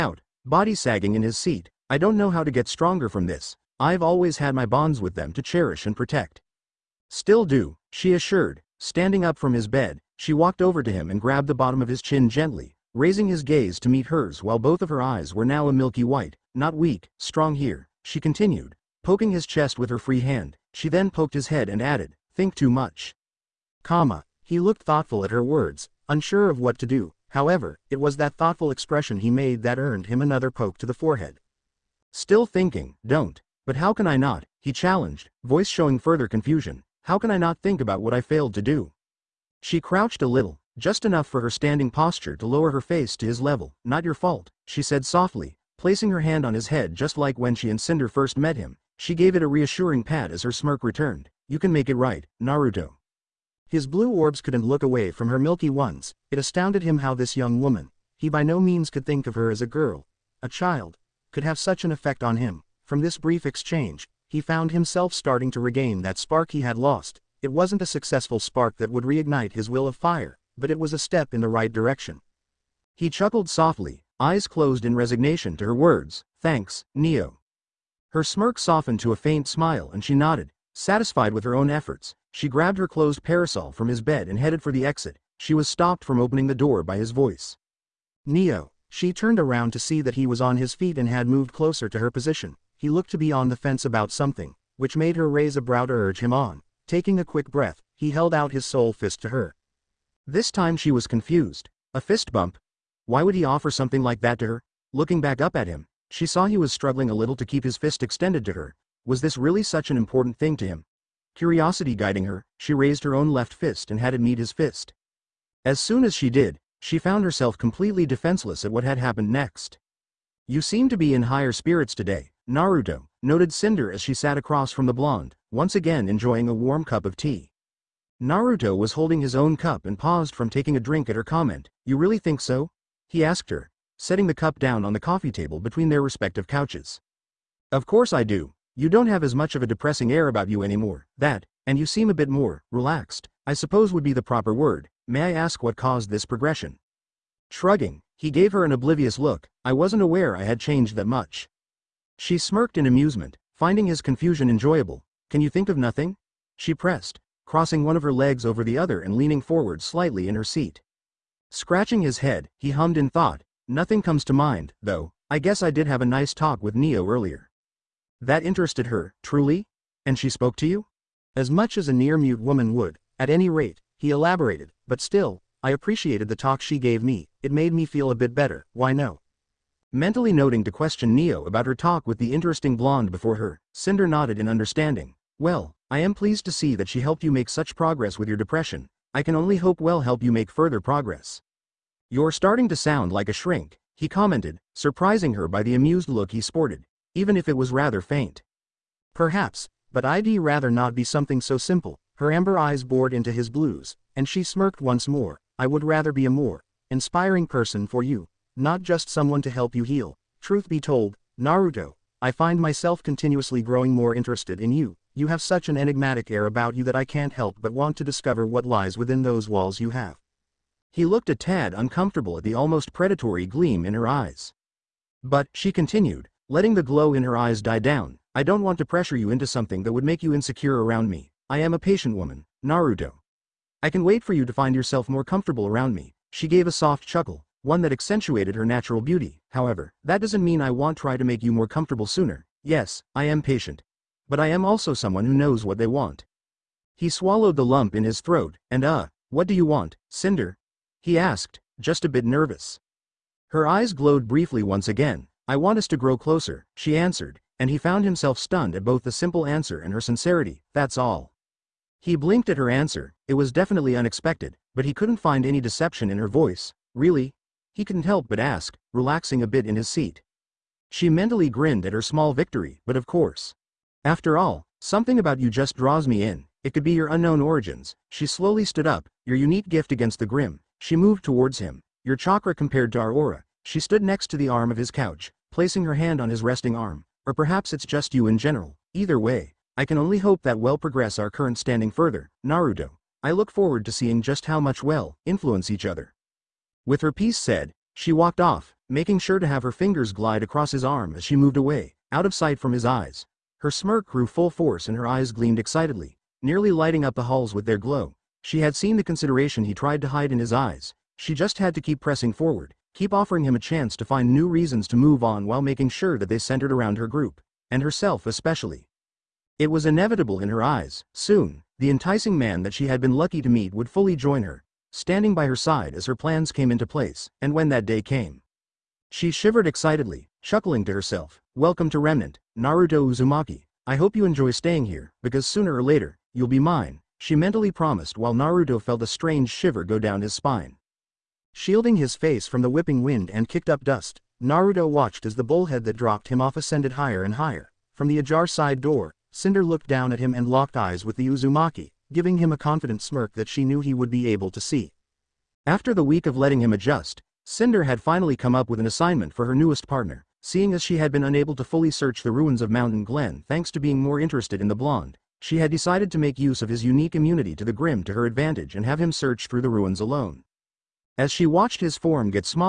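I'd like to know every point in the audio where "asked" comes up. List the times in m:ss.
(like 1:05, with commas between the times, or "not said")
2:13, 4:11.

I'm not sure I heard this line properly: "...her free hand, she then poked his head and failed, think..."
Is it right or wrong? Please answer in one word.
wrong.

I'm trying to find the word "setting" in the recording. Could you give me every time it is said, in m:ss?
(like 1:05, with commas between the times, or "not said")
2:13.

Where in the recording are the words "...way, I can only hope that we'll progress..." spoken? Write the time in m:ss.
4:49.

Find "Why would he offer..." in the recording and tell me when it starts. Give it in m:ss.
1:43.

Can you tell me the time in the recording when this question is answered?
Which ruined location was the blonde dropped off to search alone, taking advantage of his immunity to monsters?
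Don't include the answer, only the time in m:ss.
6:02.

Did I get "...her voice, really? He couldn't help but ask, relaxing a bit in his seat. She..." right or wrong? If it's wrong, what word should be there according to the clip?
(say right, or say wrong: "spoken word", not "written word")
right.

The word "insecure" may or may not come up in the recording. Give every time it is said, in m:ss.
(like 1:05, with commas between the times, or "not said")
3:50.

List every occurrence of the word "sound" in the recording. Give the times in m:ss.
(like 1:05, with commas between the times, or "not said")
3:12.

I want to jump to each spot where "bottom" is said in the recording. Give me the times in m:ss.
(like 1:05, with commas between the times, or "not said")
0:11.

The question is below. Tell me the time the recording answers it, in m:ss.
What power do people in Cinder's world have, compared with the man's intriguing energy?
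4:43.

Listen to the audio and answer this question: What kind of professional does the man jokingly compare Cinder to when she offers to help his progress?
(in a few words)
a shrink.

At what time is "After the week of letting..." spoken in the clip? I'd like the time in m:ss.
5:55.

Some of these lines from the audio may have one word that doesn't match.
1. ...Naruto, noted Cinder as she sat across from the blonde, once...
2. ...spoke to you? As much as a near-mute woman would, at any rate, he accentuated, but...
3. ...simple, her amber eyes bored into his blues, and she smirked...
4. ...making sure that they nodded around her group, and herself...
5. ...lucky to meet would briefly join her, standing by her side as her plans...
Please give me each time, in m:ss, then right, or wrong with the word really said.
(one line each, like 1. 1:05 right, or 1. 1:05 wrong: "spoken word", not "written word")
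1. 2:02 right
2. 2:50 wrong: "elaborated", not "accentuated"
3. 3:21 right
4. 5:15 wrong: "centered", not "nodded"
5. 5:23 wrong: "fully", not "briefly".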